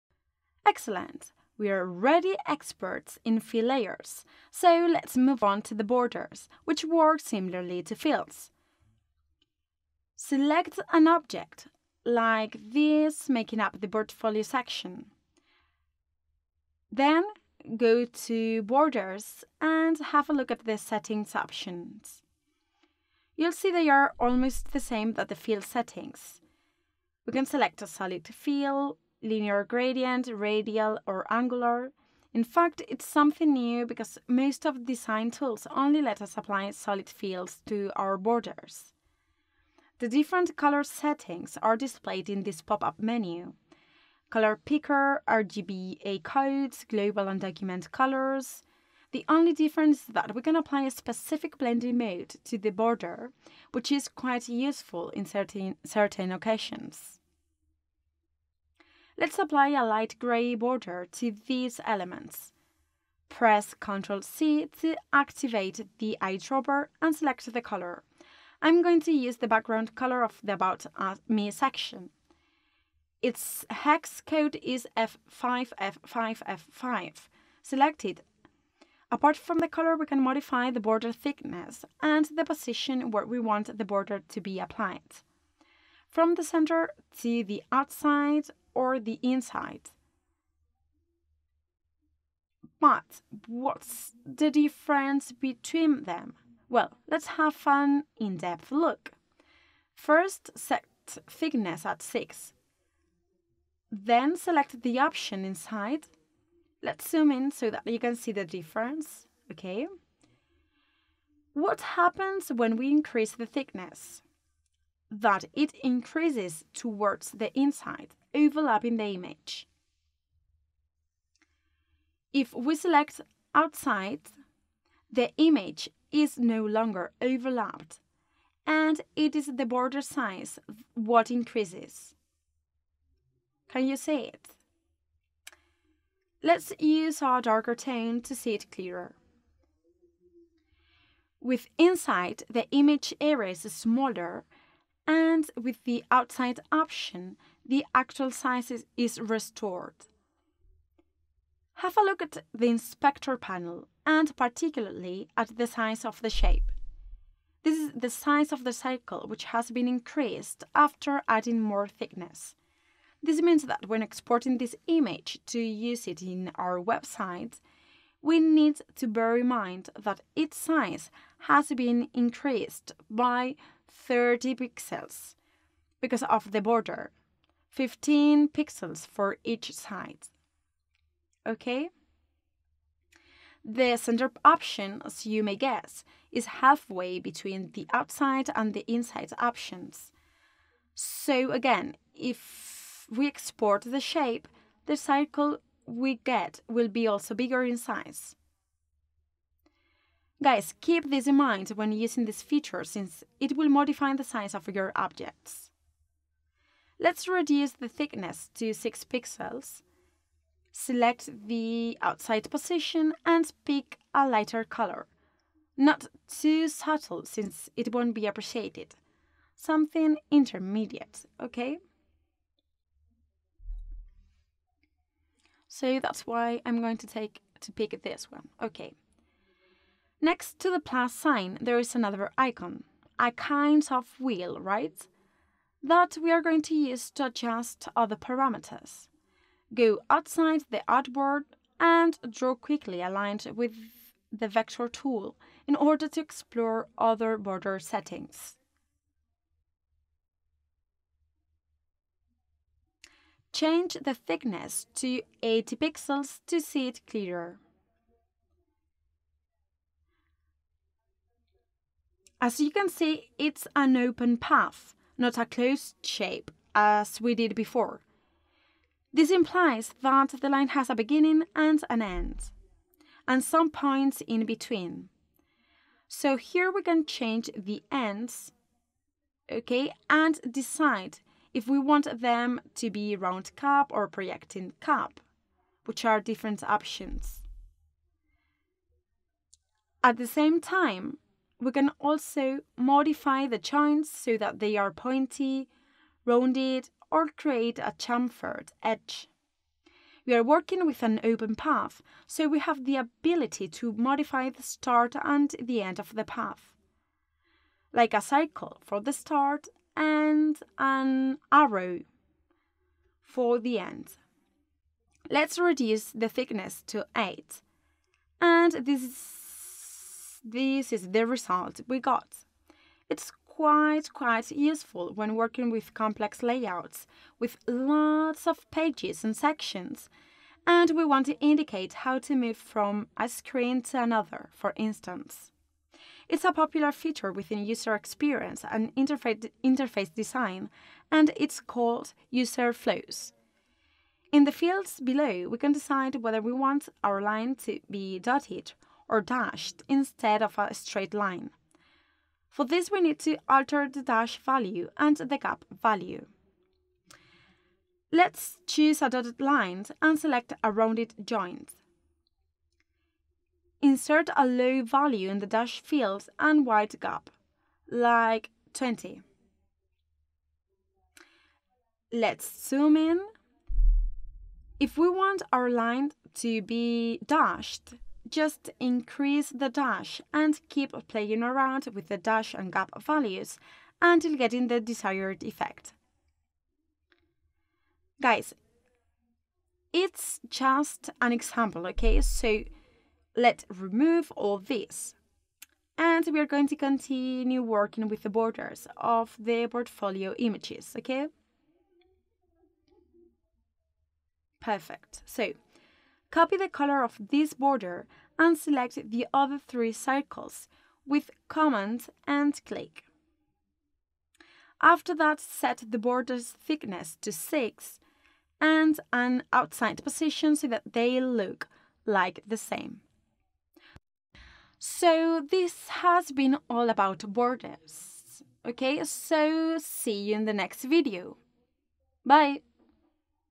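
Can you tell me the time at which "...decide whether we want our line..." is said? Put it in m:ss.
5:45.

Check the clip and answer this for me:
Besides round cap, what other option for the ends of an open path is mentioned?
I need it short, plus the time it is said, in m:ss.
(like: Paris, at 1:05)
projecting cap, at 4:44.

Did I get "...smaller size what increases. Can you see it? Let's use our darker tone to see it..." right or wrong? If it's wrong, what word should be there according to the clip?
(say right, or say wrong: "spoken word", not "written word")
wrong: "border", not "smaller".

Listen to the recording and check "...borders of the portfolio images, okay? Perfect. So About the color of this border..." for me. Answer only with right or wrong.
wrong.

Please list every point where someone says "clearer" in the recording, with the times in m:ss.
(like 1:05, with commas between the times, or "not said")
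2:18, 4:17.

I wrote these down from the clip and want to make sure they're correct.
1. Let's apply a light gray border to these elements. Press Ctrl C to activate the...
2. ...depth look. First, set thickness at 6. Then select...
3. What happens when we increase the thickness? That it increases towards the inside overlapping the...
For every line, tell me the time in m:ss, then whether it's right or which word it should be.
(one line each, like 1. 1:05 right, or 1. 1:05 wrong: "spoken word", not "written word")
1. 0:59 right
2. 1:38 right
3. 1:51 right.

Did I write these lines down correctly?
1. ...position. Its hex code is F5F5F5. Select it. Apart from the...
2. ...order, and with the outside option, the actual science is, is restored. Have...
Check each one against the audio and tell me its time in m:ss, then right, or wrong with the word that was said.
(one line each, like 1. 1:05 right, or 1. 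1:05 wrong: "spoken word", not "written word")
1. 1:11 wrong: "section", not "position"
2. 2:23 wrong: "smaller", not "order".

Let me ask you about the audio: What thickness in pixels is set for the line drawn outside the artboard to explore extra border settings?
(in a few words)
80 pixels.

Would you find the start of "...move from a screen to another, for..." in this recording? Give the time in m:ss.
5:32.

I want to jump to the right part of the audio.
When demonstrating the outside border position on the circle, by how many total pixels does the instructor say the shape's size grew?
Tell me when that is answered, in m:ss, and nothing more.
2:53.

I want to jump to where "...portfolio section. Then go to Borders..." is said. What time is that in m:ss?
0:13.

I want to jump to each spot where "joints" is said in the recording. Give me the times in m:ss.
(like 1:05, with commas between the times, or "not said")
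4:53, 6:01.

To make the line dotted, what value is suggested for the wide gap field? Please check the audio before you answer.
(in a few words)
20.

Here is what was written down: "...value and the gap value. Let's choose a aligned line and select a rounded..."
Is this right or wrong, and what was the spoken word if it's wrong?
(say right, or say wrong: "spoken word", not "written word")
wrong: "dotted", not "aligned".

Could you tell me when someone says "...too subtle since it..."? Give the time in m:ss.
3:36.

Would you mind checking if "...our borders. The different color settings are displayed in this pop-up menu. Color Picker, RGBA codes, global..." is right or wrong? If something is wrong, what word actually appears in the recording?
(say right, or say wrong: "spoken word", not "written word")
right.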